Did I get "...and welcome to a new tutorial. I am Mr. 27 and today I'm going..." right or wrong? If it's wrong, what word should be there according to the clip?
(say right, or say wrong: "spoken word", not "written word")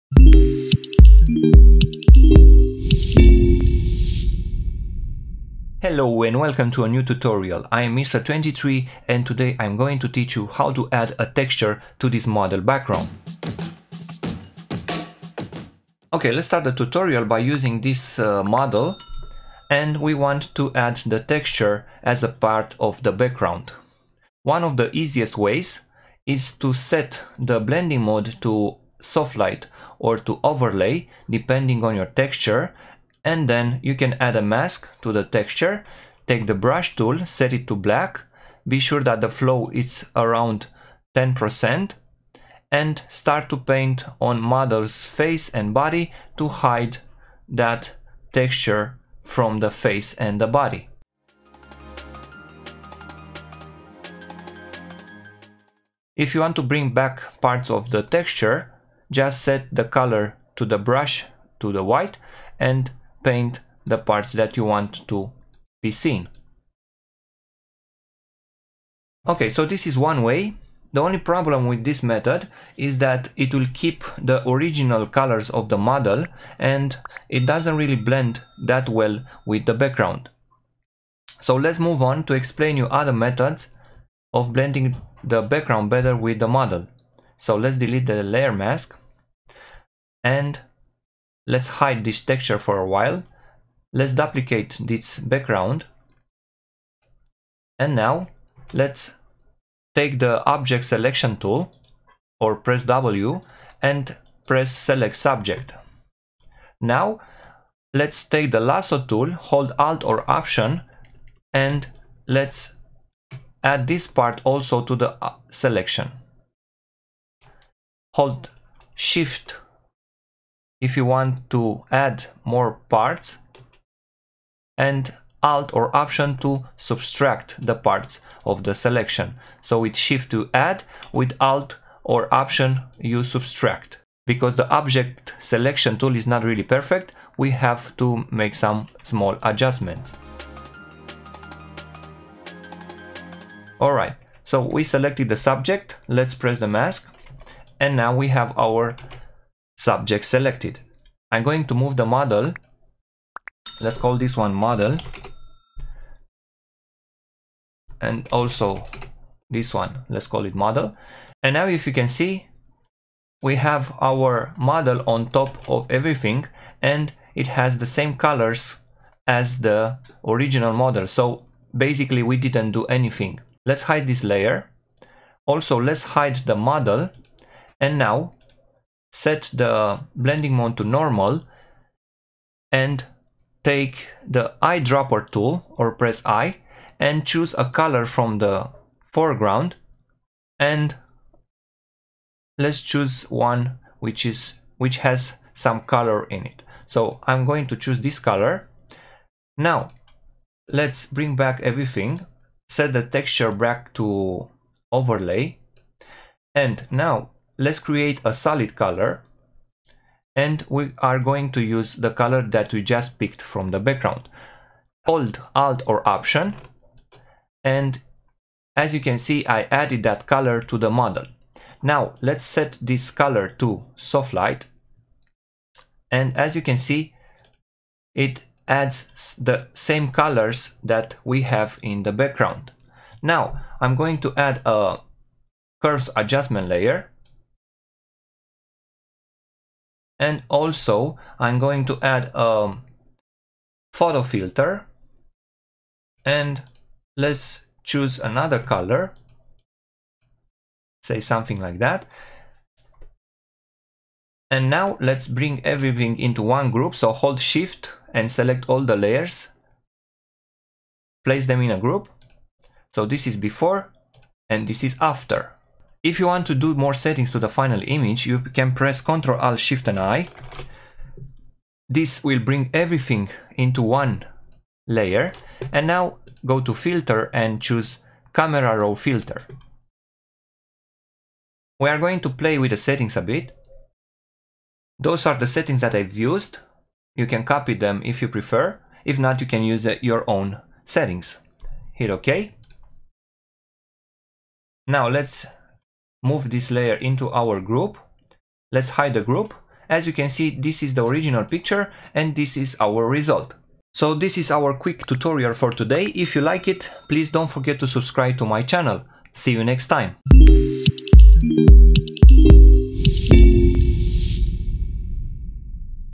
wrong: "23", not "27".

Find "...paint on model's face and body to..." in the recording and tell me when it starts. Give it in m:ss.
0:43.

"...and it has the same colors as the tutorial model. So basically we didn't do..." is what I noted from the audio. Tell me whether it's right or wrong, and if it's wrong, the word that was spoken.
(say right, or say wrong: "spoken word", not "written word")
wrong: "original", not "tutorial".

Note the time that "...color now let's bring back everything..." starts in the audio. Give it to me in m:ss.
3:18.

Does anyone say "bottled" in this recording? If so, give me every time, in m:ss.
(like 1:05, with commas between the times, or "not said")
not said.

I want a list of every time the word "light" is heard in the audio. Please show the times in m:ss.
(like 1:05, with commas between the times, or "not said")
0:29, 3:44.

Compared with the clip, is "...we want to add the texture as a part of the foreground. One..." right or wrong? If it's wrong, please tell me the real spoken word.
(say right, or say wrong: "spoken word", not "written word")
wrong: "background", not "foreground".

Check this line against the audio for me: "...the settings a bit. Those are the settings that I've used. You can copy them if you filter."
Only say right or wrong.
wrong.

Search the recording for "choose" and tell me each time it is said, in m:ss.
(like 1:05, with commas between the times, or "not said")
3:07, 3:12, 3:17, 4:07, 4:37.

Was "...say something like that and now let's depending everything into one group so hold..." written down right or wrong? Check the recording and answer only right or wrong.
wrong.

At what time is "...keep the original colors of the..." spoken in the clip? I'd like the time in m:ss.
1:13.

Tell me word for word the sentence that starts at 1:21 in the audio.
So let's move on to explain you other methods of blending the background better with the model.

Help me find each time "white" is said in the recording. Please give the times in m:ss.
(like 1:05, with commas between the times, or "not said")
1:01.